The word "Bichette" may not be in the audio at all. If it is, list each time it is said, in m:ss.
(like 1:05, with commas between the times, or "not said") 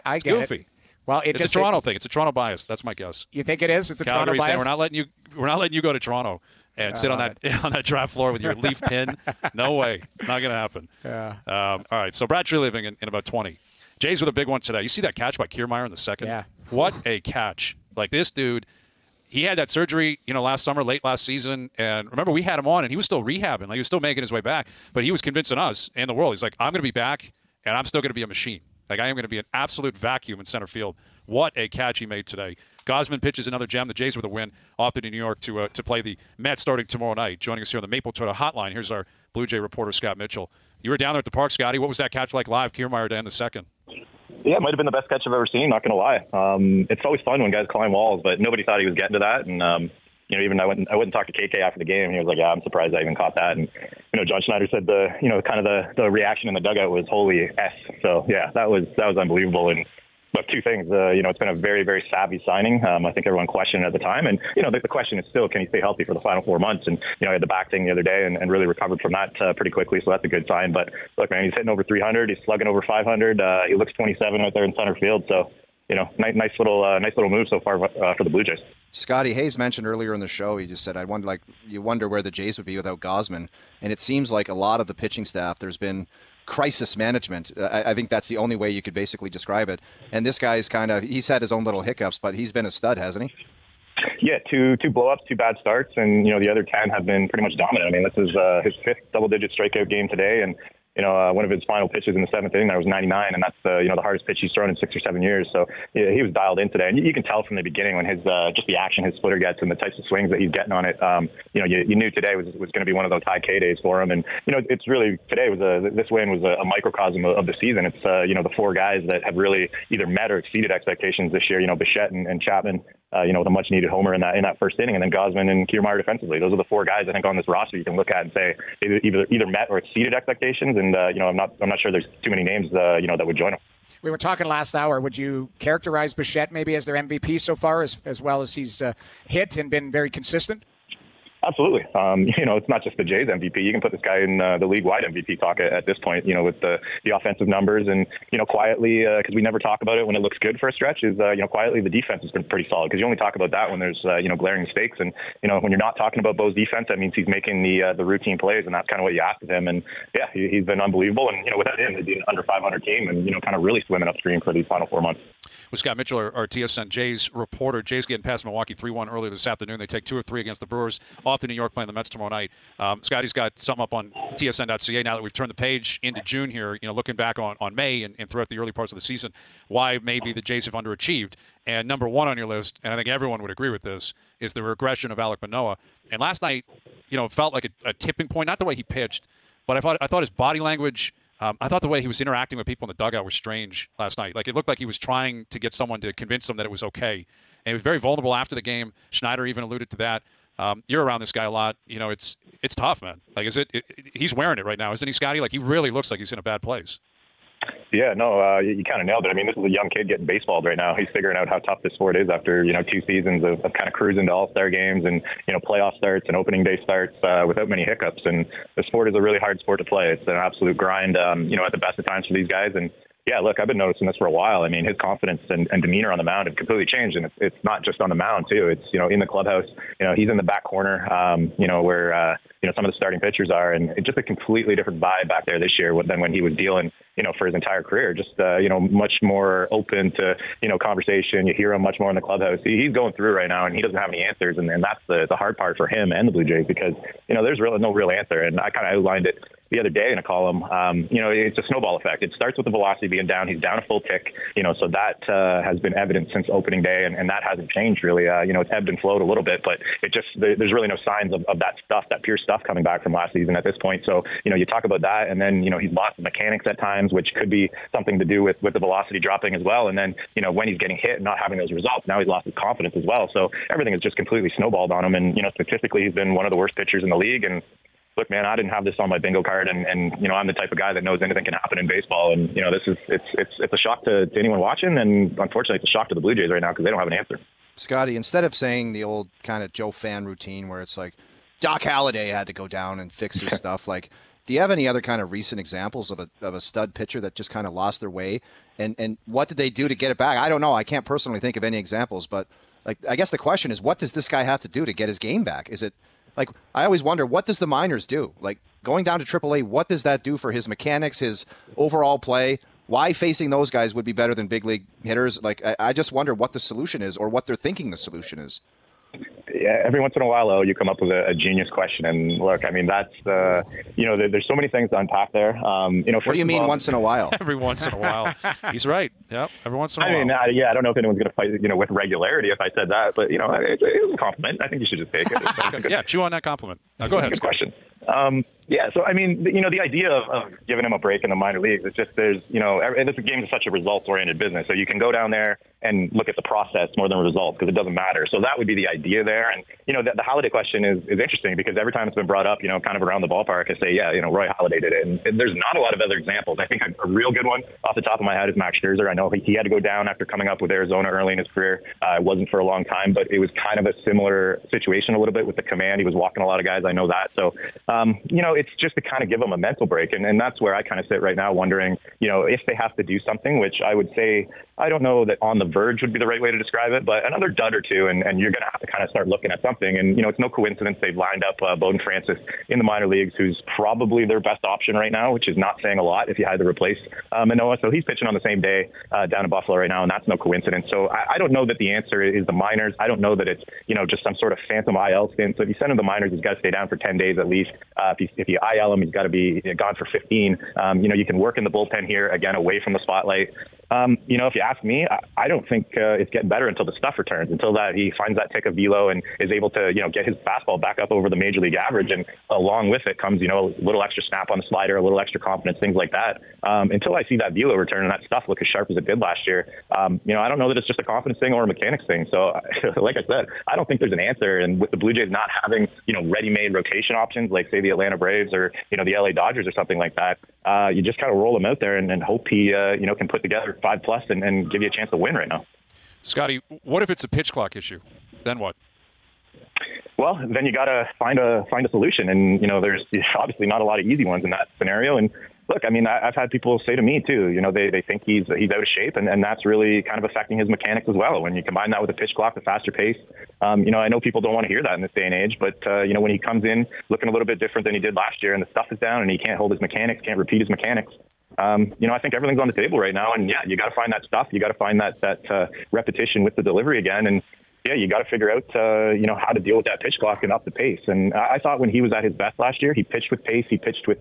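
2:01, 2:16.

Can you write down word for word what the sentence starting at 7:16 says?
Scotty, what if it's a pitch clock issue?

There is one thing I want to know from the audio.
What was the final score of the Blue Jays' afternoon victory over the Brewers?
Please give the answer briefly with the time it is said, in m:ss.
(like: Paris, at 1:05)
3-1, at 2:48.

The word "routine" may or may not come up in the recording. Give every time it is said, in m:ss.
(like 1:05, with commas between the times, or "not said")
2:38, 4:50.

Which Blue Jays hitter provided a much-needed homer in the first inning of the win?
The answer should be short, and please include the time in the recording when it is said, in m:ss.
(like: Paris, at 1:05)
Chapman, at 2:02.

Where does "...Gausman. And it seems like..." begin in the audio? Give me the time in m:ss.
1:23.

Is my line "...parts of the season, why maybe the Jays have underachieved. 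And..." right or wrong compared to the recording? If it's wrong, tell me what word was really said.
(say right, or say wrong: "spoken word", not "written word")
right.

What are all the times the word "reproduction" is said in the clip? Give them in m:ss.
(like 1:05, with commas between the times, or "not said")
not said.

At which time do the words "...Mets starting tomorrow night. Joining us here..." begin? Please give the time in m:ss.
0:36.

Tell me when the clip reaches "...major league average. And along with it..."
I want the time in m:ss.
6:51.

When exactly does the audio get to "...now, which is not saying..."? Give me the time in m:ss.
6:25.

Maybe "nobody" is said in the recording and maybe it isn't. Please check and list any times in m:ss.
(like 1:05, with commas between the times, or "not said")
0:48.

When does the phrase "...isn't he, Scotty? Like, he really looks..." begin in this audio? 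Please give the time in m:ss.
3:24.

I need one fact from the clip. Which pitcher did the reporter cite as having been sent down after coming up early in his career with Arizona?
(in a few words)
Max Scherzer.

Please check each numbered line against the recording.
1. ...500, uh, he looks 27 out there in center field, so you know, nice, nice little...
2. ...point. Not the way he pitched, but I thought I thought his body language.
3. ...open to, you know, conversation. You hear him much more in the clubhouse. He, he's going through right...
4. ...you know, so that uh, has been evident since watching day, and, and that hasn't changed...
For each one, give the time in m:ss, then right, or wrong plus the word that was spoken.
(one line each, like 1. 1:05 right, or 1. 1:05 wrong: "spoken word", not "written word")
1. 1:12 right
2. 3:08 right
3. 3:59 right
4. 4:14 wrong: "opening", not "watching".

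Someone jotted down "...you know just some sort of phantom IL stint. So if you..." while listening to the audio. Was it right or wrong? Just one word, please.
right.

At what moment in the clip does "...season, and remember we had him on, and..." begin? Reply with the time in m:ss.
0:21.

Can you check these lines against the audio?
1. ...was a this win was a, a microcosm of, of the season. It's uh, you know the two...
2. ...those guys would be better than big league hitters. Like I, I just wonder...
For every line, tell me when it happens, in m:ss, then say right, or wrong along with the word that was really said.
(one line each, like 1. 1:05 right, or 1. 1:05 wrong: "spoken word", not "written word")
1. 1:55 wrong: "four", not "two"
2. 5:13 right.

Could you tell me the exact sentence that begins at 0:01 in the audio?
Well, it it's just, a Toronto it, thing.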